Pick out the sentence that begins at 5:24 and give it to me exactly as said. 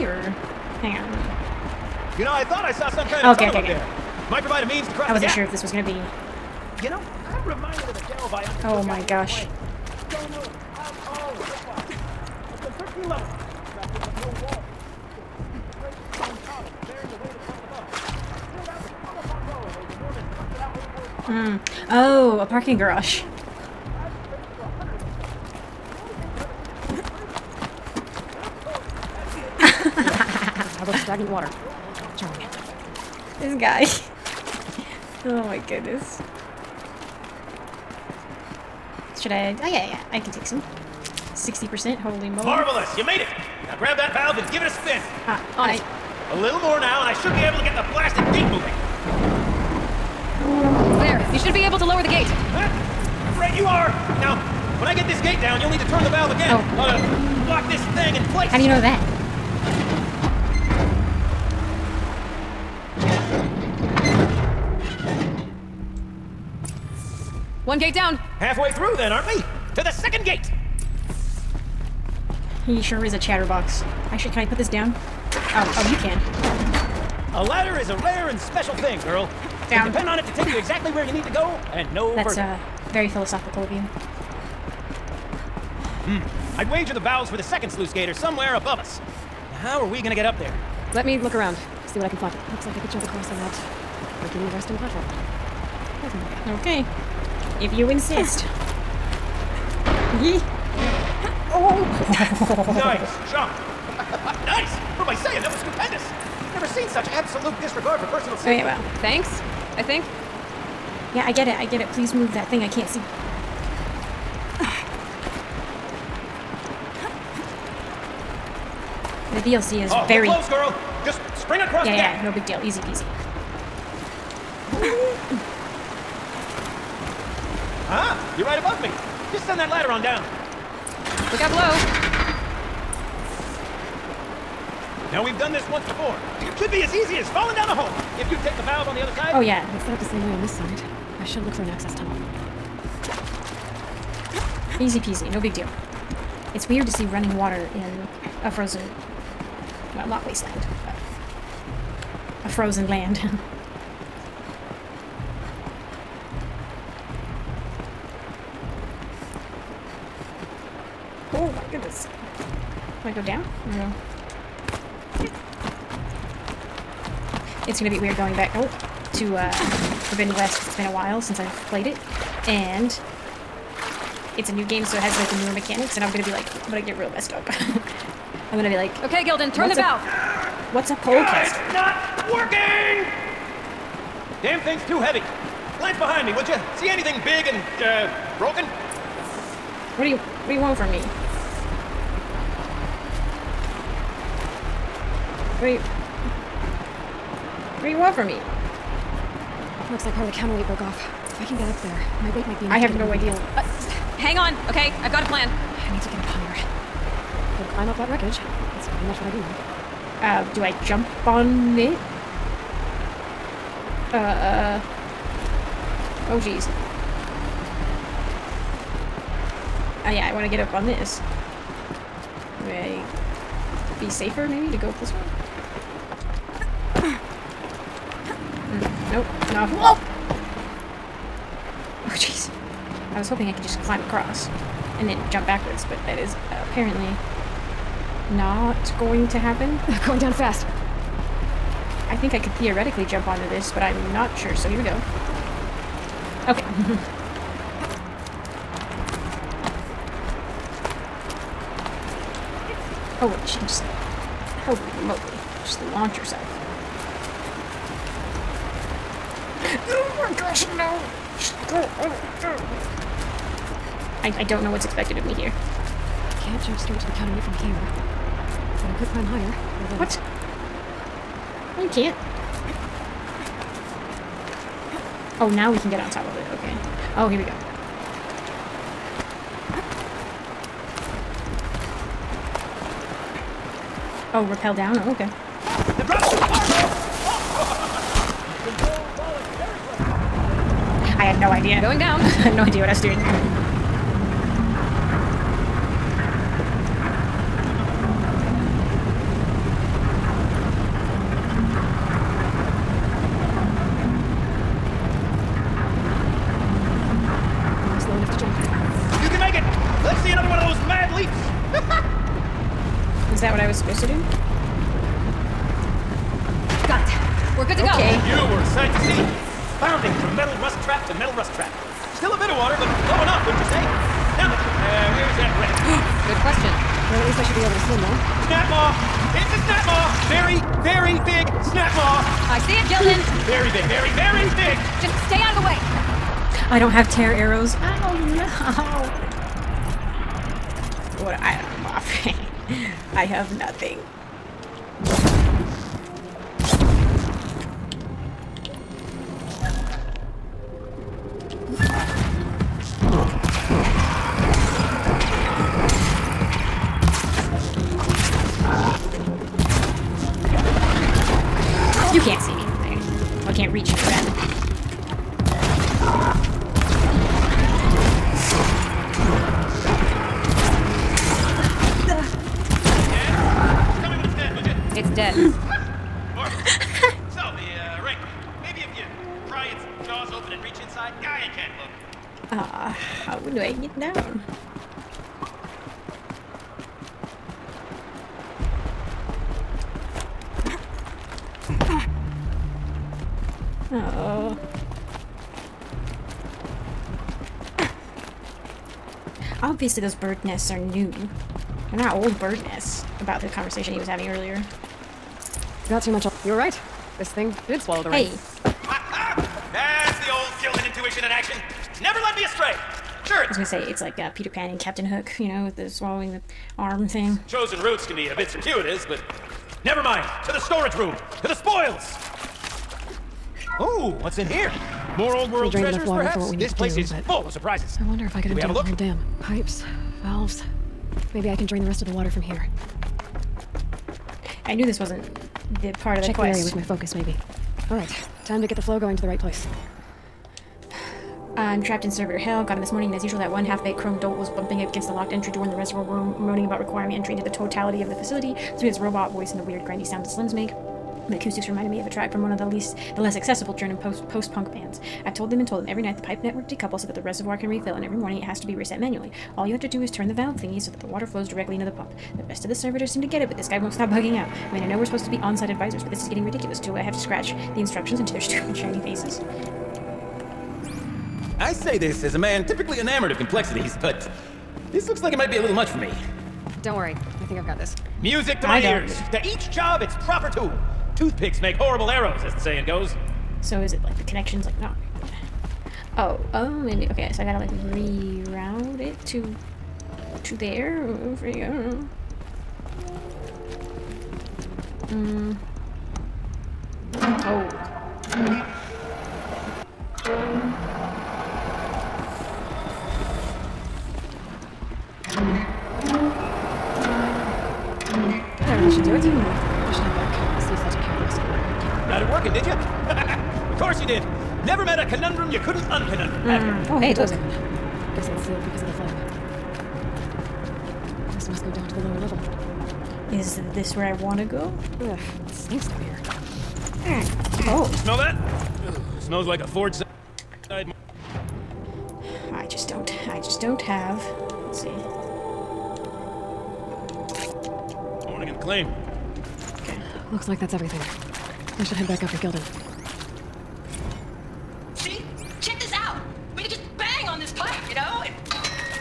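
Now then, uh, where's that wreck?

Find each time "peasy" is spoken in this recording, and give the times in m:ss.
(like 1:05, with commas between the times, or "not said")
2:02, 2:24.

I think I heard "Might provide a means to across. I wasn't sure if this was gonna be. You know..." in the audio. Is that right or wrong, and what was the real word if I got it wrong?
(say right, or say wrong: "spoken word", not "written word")
wrong: "cross", not "across".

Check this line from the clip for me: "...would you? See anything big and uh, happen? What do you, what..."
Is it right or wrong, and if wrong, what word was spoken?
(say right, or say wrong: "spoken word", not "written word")
wrong: "broken", not "happen".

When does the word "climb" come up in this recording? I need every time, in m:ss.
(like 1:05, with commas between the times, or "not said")
3:27, 3:53, 4:29.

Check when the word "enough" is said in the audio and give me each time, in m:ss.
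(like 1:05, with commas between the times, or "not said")
3:22, 5:23.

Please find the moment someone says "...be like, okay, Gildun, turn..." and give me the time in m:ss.
2:58.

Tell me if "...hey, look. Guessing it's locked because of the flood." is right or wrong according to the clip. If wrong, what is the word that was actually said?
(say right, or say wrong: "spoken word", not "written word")
wrong: "sealed", not "locked".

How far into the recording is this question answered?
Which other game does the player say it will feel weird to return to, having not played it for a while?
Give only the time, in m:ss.
2:50.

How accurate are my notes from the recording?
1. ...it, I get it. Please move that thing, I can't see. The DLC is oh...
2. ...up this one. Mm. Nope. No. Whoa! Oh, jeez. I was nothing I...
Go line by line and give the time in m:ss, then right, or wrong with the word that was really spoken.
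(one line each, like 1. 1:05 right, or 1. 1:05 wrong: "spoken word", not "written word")
1. 1:51 right
2. 3:44 wrong: "hoping", not "nothing".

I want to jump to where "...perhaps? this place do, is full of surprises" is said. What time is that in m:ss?
7:06.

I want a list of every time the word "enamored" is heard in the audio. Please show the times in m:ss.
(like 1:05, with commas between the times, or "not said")
7:52.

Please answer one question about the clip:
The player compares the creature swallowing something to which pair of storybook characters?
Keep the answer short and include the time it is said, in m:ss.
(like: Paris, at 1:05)
Peter Pan and Captain Hook, at 6:54.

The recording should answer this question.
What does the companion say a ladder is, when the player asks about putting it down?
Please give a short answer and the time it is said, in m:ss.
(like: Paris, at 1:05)
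A rare and special thing, at 1:17.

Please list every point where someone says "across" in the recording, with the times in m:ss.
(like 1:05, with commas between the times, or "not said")
1:33, 2:01, 3:54.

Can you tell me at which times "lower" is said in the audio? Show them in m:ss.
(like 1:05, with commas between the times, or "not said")
0:51, 8:41.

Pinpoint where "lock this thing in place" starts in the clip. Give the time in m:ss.
0:57.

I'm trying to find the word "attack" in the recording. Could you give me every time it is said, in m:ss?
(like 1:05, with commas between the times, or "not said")
not said.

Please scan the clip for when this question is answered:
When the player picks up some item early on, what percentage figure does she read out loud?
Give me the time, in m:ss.
0:41.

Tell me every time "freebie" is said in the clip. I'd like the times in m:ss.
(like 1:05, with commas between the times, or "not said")
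not said.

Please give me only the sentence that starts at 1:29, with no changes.
How are we gonna get up there?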